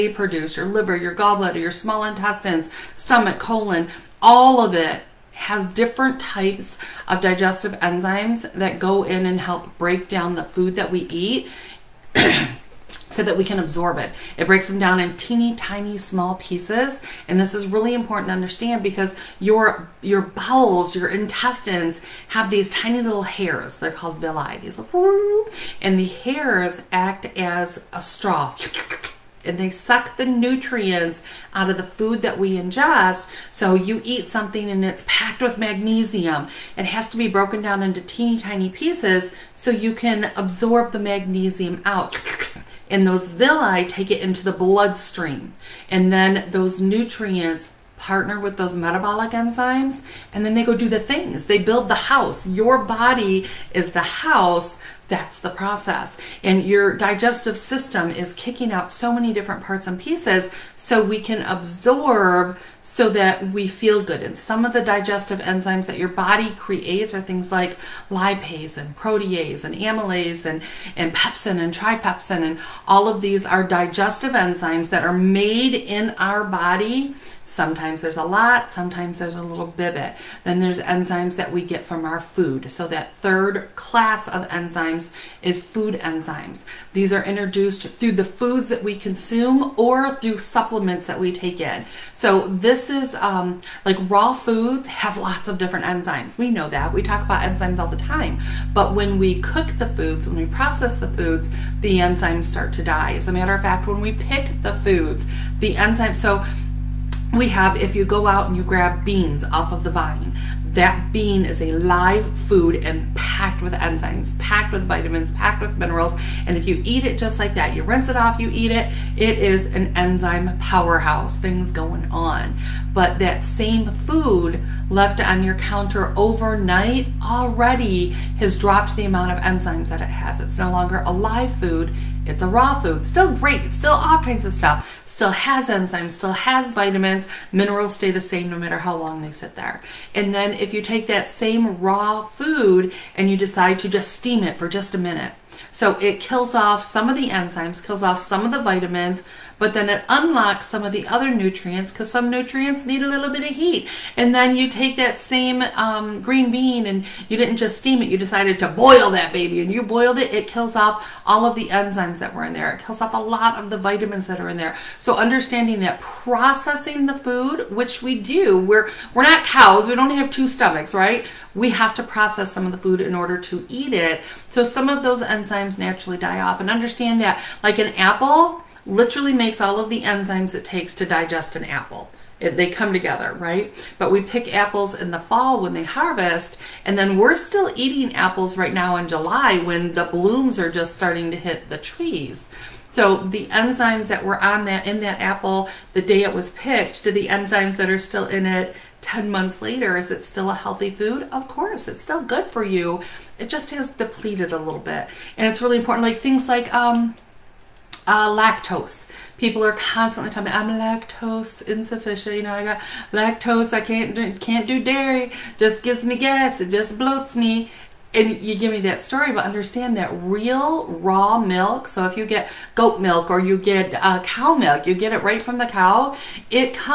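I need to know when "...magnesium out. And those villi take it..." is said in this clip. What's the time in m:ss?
0:40.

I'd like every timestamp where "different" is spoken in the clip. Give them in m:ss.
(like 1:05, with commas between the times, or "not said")
0:05, 0:59, 1:35.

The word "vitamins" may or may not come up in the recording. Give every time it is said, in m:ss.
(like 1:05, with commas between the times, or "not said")
1:54, 2:16, 2:28, 2:43.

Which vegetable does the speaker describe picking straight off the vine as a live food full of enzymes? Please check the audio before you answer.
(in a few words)
beans.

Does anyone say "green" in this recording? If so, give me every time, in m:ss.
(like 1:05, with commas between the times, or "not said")
2:36.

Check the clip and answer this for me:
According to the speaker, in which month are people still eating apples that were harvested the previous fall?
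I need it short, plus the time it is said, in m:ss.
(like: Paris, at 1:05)
July, at 3:09.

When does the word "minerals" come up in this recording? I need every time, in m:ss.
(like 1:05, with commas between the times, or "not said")
1:55, 2:17.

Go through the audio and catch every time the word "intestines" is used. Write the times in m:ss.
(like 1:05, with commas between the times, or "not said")
0:02, 0:21.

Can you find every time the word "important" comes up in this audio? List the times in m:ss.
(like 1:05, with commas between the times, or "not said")
0:17, 3:25.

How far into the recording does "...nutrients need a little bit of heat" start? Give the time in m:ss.
2:32.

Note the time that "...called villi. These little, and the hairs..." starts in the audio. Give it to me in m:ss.
0:23.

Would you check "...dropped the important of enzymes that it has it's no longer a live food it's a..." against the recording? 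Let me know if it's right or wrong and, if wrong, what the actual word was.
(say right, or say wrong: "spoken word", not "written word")
wrong: "amount", not "important".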